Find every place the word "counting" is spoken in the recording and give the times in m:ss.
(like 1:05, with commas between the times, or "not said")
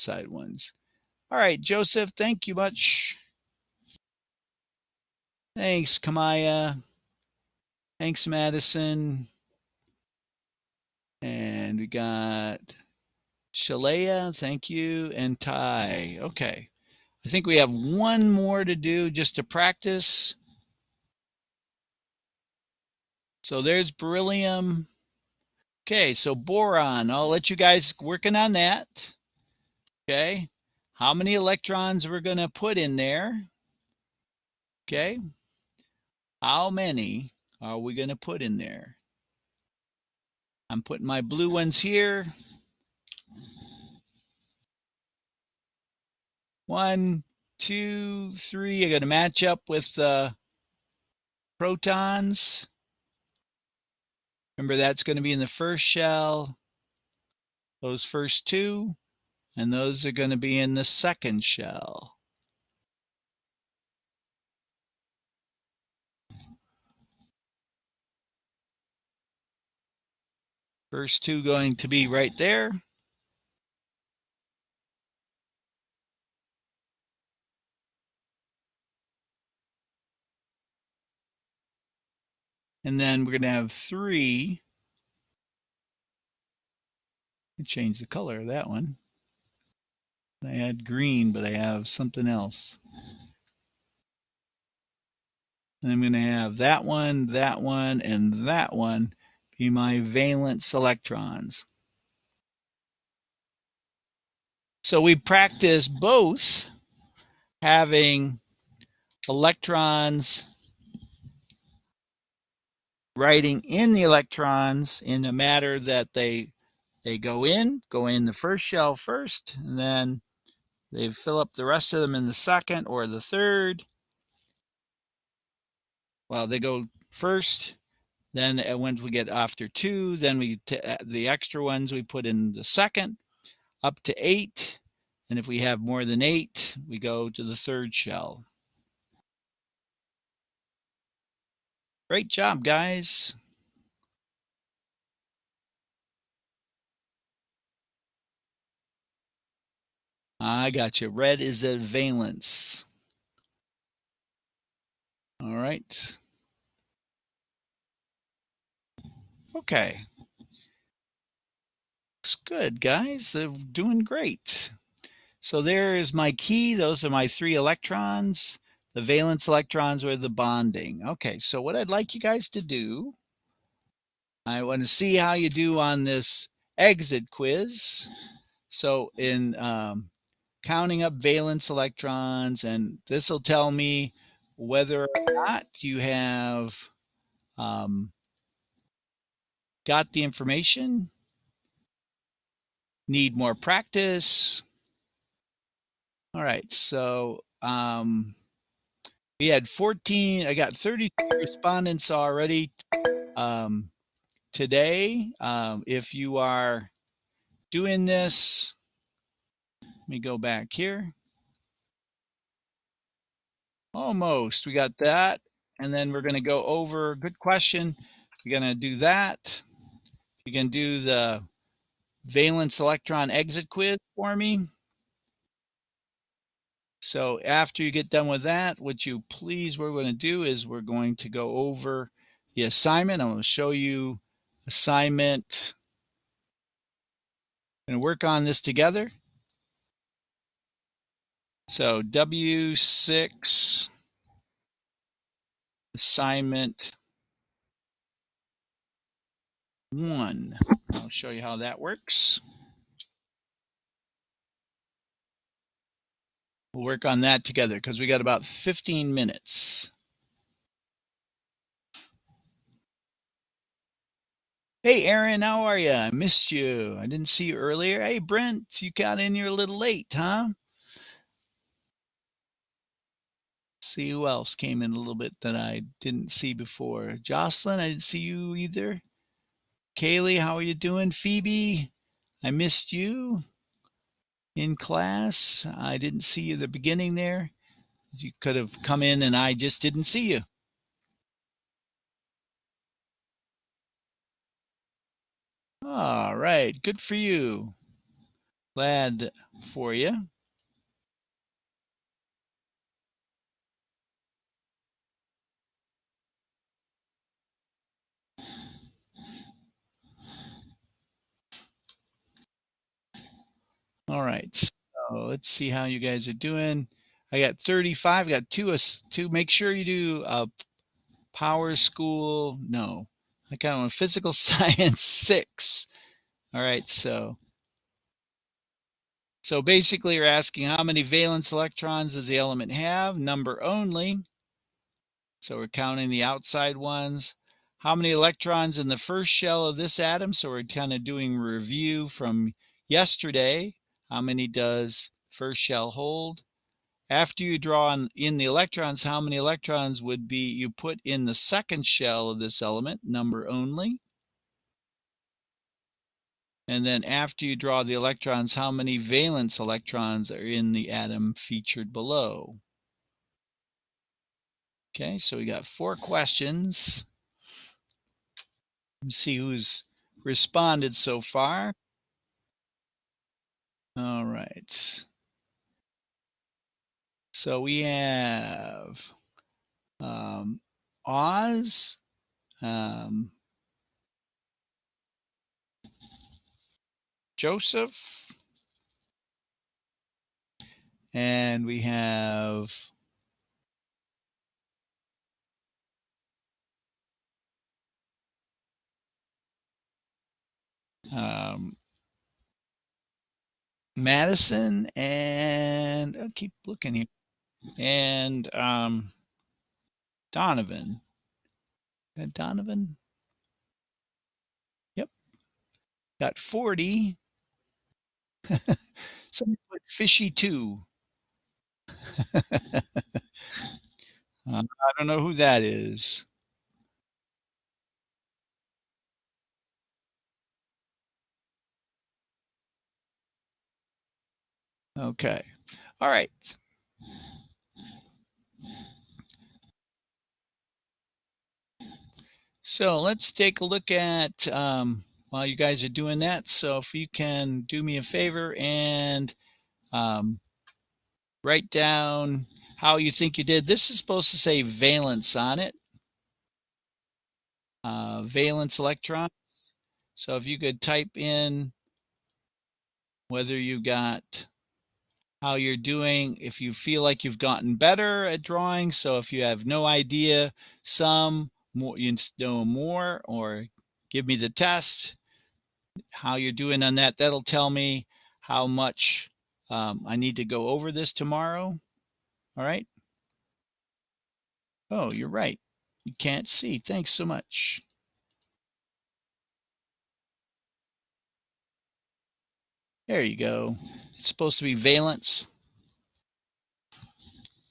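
3:00, 5:35.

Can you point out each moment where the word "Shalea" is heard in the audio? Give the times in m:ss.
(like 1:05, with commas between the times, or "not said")
0:13.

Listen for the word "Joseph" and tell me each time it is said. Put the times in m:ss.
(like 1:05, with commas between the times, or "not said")
0:01, 6:27.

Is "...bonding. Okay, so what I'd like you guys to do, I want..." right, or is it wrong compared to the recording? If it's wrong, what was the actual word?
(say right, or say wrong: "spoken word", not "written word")
right.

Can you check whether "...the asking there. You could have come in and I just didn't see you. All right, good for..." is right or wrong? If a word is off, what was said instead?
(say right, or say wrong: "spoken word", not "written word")
wrong: "beginning", not "asking".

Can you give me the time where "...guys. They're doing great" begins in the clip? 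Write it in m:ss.
2:42.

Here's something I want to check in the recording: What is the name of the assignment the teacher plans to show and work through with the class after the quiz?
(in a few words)
W6 assignment one.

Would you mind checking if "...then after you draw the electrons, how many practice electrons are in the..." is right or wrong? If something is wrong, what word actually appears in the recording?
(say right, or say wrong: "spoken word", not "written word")
wrong: "valence", not "practice".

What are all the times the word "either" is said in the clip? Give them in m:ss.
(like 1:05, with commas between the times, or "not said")
4:38.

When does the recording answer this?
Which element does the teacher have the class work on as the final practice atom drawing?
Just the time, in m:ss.
0:26.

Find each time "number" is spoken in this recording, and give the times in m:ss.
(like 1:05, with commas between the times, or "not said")
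5:33, 5:53.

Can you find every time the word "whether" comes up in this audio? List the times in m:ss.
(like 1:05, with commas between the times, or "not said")
3:04, 7:43.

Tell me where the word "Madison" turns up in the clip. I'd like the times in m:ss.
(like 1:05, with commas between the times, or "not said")
0:08, 6:44.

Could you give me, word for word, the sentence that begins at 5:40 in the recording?
So we're kind of doing review from yesterday how many does first shell hold?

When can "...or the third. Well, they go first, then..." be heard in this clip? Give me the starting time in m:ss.
2:02.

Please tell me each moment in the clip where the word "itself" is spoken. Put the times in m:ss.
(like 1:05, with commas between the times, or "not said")
not said.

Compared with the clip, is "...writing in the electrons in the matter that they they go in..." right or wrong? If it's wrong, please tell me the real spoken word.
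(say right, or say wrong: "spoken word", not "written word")
right.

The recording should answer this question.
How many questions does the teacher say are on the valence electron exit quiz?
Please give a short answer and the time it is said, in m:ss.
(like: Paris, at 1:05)
4, at 6:05.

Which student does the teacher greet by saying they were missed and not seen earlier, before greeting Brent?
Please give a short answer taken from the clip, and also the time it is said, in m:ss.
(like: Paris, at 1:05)
Aaron, at 4:25.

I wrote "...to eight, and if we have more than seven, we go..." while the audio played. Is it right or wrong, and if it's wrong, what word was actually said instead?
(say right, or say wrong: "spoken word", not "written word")
wrong: "eight", not "seven".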